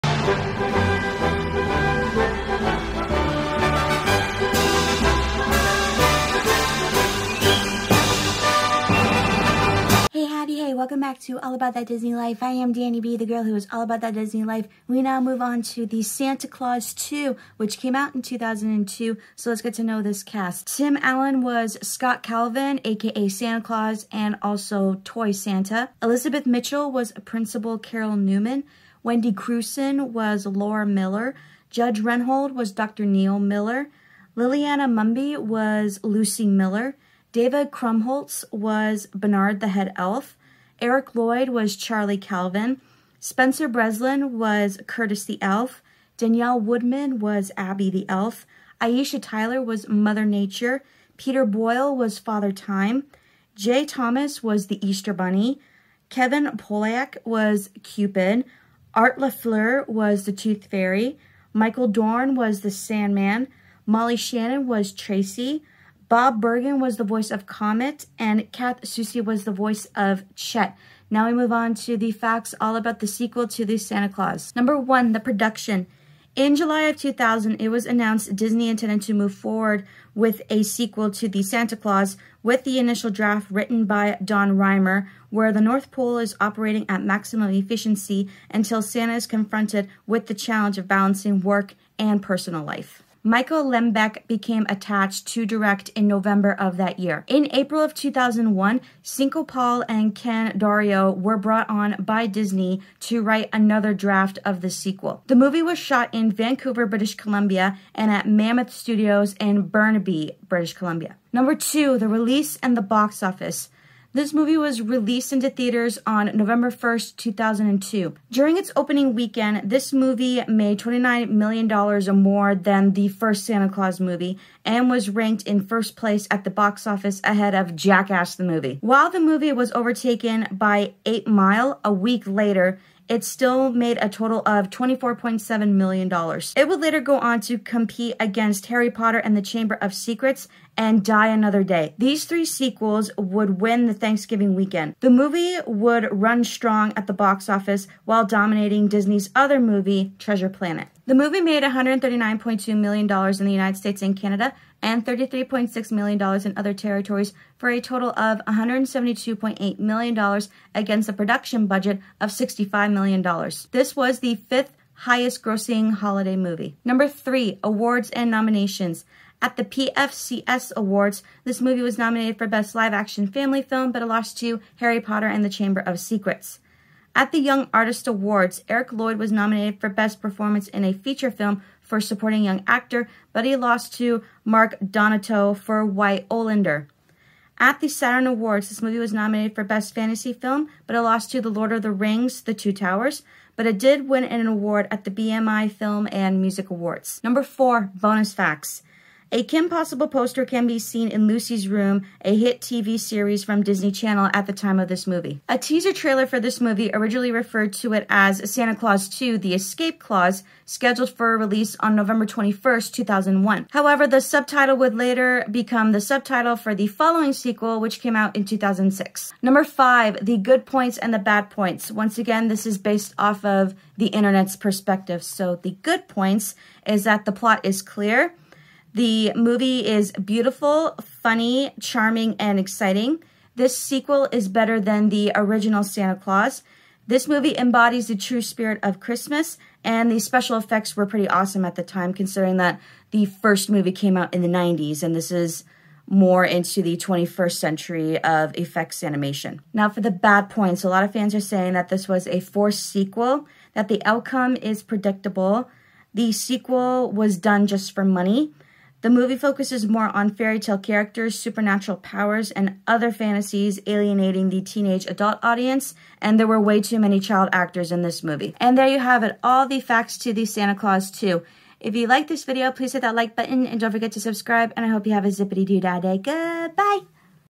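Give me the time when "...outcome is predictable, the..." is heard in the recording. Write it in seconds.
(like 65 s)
254 s.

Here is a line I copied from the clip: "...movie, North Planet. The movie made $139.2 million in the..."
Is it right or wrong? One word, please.
wrong.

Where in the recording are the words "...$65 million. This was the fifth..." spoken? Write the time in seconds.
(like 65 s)
162 s.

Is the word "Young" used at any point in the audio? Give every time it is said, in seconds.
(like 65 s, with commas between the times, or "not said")
177 s, 182 s.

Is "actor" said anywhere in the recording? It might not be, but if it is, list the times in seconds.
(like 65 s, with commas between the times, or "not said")
182 s, 267 s.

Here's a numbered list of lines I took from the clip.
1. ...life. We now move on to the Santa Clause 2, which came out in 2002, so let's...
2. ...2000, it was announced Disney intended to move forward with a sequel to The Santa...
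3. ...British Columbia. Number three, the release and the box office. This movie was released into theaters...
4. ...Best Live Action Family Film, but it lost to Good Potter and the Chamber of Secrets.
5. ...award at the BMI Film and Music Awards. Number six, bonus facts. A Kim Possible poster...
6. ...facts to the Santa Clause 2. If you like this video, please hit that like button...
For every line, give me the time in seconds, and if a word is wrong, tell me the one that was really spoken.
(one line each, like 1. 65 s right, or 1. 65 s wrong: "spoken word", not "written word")
1. 14 s right
2. 76 s right
3. 110 s wrong: "two", not "three"
4. 172 s wrong: "Harry", not "Good"
5. 194 s wrong: "four", not "six"
6. 269 s right.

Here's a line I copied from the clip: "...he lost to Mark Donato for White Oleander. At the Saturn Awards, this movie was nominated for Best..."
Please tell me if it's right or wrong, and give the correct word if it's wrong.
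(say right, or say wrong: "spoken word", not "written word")
right.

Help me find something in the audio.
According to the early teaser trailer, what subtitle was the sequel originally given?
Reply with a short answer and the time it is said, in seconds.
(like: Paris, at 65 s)
The Escape Clause, at 209 s.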